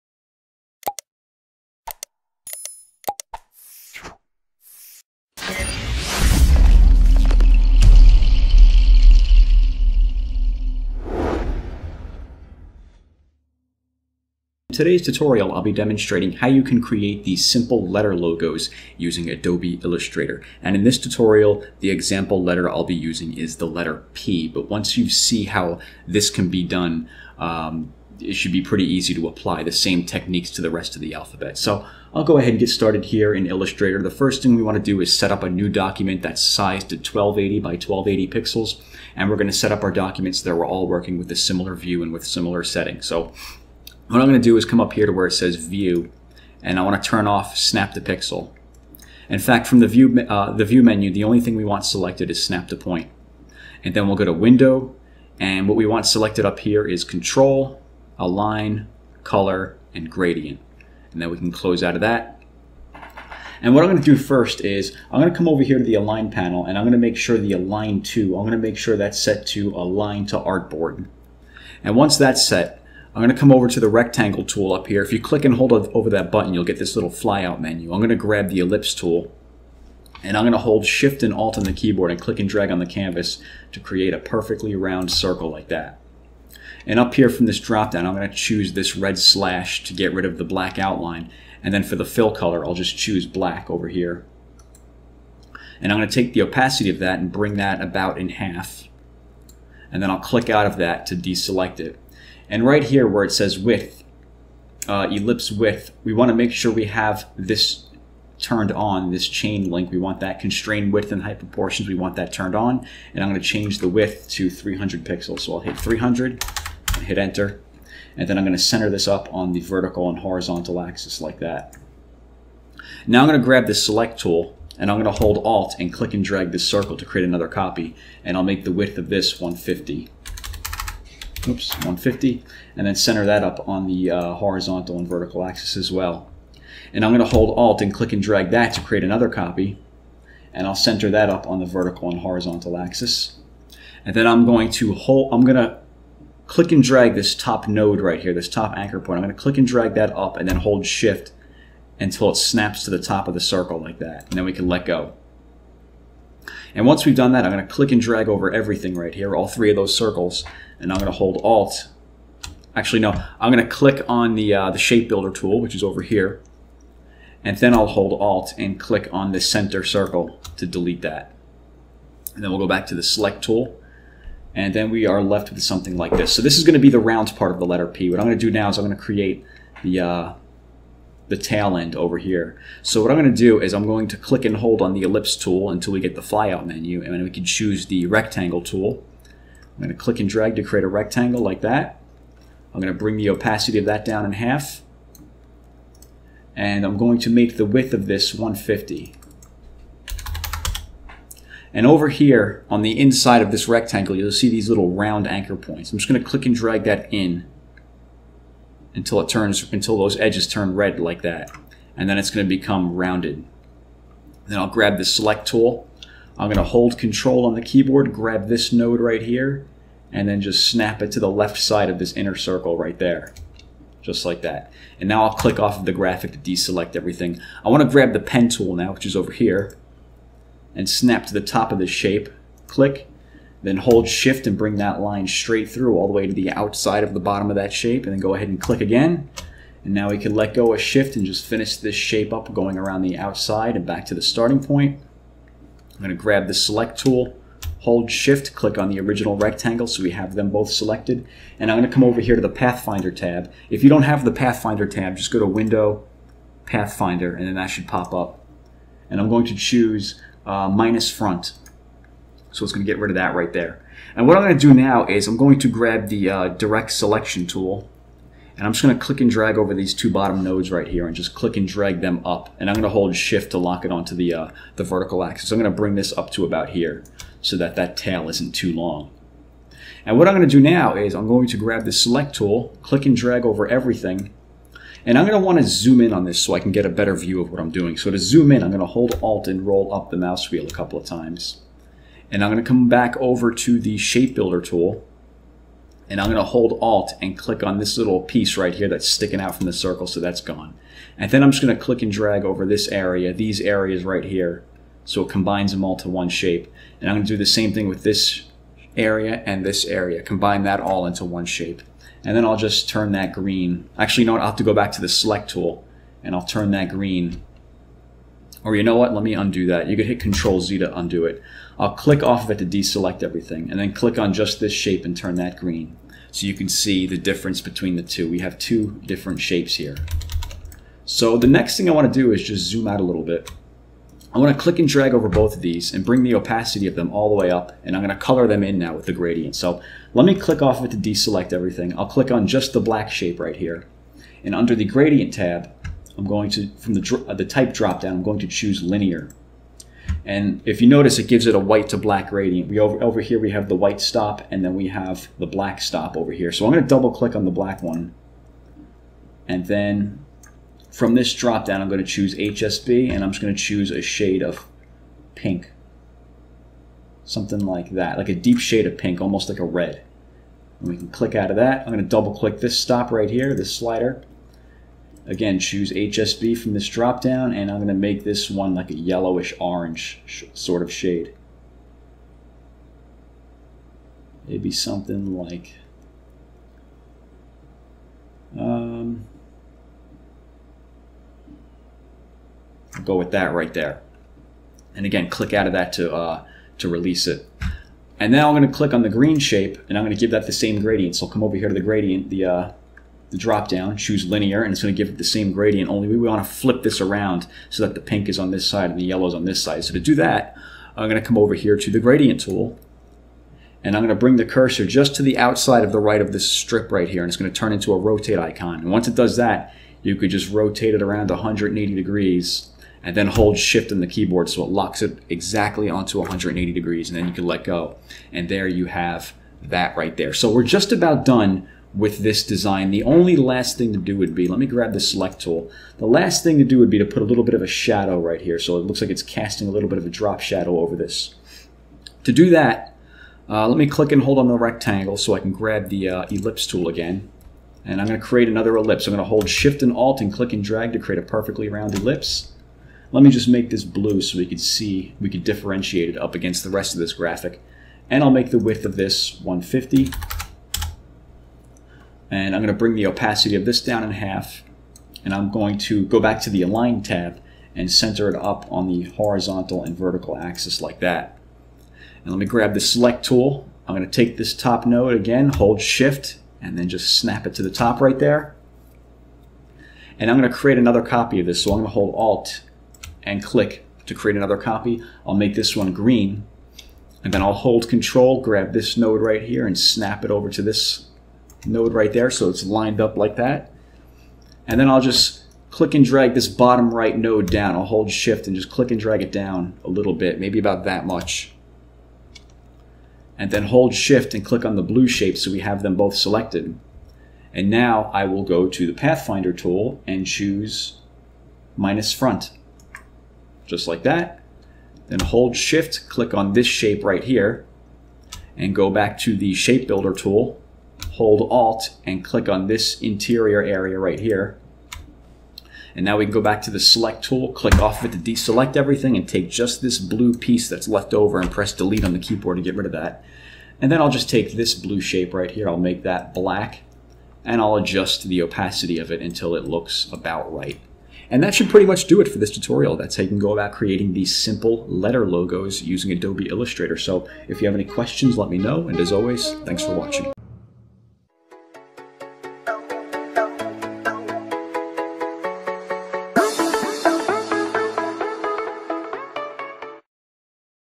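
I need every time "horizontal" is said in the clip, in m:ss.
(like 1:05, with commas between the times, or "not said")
2:00, 2:14, 2:22, 7:49.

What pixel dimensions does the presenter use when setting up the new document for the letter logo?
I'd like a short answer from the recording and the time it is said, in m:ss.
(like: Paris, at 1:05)
1280 by 1280, at 0:36.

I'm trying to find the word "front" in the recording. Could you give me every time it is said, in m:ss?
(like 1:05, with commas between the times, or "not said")
4:21, 8:32.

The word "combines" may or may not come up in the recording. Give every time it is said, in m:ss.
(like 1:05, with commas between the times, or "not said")
5:05, 5:10.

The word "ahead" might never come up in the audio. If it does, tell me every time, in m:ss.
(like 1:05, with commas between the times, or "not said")
0:32, 3:58.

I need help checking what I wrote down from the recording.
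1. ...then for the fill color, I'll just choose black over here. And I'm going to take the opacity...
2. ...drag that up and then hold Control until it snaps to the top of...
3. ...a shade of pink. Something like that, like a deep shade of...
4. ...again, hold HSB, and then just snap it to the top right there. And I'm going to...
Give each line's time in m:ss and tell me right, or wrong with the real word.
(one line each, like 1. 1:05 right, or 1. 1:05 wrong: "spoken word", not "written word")
1. 1:31 right
2. 2:29 wrong: "Shift", not "Control"
3. 6:03 right
4. 7:55 wrong: "Shift", not "HSB".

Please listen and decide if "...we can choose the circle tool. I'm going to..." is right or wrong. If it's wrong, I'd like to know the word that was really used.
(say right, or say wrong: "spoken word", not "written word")
wrong: "rectangle", not "circle".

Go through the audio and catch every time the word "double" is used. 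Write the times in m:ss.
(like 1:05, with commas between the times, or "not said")
5:56, 6:12.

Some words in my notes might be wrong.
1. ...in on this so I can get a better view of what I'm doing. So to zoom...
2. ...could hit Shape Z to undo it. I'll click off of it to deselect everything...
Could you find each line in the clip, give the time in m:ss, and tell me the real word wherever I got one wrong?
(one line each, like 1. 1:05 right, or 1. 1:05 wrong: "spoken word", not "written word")
1. 4:46 right
2. 5:19 wrong: "Control", not "Shape".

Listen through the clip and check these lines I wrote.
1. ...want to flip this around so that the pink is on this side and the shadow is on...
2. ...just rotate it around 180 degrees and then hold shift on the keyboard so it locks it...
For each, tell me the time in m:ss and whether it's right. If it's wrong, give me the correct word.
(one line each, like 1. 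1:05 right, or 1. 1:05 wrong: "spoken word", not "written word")
1. 6:46 wrong: "yellow", not "shadow"
2. 7:00 right.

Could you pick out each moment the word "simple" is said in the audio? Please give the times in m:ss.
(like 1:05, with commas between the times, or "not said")
0:17, 9:04.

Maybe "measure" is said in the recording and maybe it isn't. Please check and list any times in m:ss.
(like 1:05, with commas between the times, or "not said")
not said.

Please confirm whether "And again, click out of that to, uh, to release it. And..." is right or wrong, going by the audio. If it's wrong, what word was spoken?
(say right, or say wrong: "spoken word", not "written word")
right.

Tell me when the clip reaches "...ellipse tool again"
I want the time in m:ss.
7:26.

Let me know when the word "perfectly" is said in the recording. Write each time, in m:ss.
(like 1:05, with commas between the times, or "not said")
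1:24, 7:31.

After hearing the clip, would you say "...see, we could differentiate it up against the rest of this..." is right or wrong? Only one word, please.
right.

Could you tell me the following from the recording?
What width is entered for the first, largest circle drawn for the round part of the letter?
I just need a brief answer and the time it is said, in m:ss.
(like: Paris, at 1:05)
300 pixels, at 1:54.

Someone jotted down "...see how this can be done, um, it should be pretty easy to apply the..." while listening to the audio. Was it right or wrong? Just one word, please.
right.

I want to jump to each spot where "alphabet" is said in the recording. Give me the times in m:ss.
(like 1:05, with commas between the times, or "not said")
0:31.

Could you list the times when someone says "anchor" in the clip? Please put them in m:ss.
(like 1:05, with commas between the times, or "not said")
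2:28, 3:25.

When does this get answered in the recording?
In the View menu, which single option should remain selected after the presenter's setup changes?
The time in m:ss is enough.
0:52.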